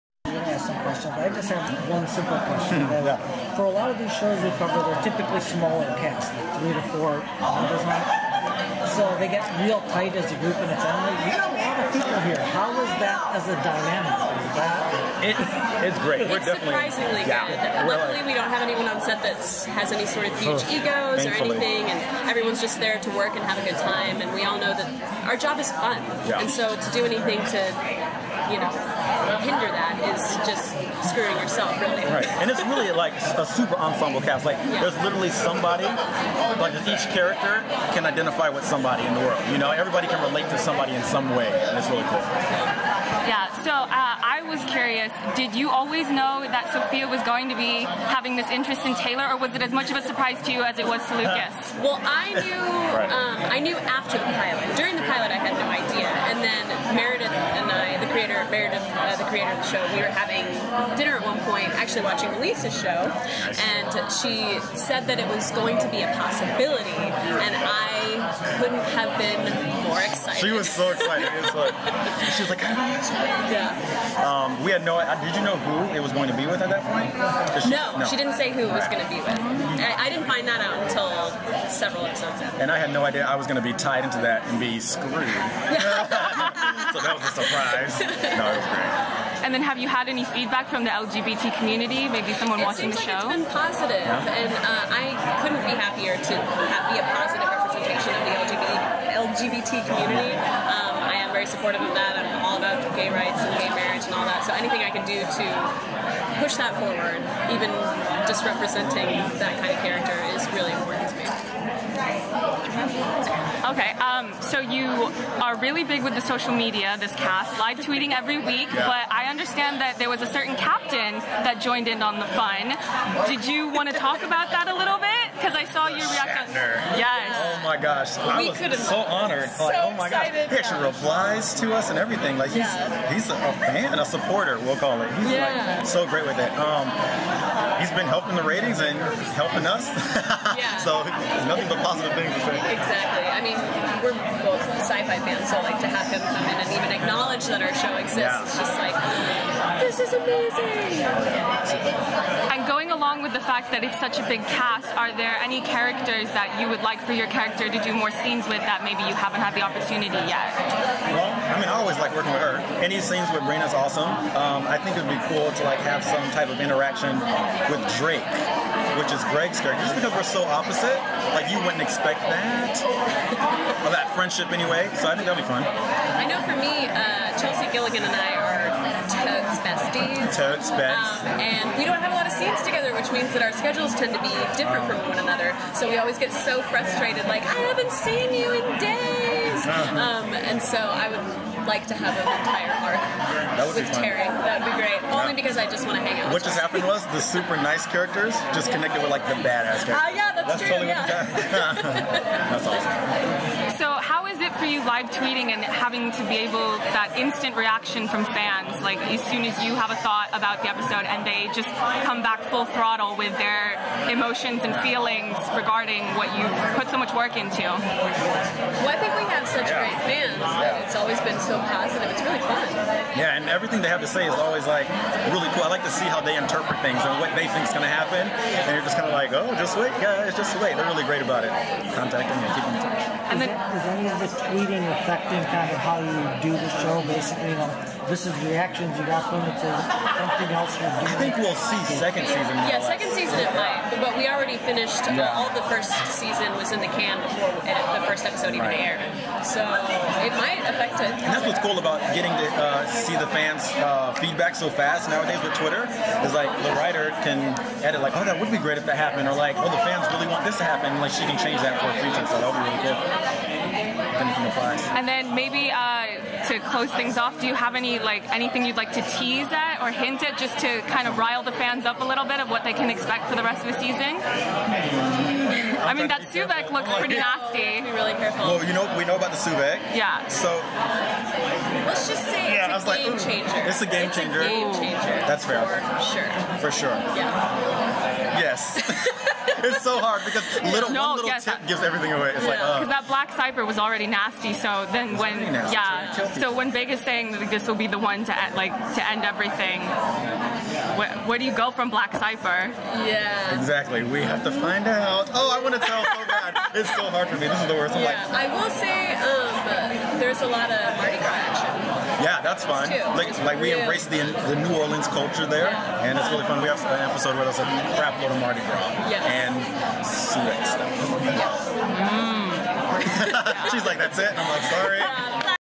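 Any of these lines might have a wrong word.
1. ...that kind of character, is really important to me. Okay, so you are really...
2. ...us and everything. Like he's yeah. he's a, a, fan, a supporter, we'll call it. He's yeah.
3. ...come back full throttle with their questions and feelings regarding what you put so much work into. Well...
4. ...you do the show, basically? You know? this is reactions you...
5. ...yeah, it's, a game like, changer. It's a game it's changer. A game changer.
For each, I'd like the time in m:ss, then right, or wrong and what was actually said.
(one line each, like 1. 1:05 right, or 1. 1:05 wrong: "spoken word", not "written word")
1. 1:49 right
2. 2:11 right
3. 3:32 wrong: "emotions", not "questions"
4. 3:56 right
5. 4:42 right.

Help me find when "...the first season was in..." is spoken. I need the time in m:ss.
4:05.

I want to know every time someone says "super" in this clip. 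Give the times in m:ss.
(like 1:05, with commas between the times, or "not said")
0:33, 3:17.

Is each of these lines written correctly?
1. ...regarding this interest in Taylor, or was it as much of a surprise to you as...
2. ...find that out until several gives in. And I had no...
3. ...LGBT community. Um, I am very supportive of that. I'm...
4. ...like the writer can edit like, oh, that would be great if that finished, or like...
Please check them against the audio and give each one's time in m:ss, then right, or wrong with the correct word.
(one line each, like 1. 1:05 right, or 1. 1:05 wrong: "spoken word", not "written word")
1. 0:48 wrong: "having", not "regarding"
2. 1:20 wrong: "episodes", not "gives"
3. 1:39 right
4. 4:16 wrong: "happened", not "finished".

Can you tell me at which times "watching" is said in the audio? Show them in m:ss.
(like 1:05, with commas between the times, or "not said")
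1:02, 1:32.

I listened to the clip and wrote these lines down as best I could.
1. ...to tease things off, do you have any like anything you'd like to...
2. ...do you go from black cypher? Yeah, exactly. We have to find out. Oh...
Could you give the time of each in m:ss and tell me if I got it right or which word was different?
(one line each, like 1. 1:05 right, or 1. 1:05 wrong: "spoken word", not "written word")
1. 4:26 wrong: "close", not "tease"
2. 5:01 right.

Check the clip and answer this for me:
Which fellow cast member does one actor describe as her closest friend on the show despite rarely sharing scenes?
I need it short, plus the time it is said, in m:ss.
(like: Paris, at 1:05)
Chelsea Gilligan, at 2:57.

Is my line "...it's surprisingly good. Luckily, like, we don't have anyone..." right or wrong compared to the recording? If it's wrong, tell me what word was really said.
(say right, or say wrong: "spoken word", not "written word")
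right.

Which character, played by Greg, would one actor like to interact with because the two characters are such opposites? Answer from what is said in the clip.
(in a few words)
Drake.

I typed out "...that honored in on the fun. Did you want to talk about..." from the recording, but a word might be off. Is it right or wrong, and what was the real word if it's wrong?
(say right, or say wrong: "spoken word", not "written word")
wrong: "joined", not "honored".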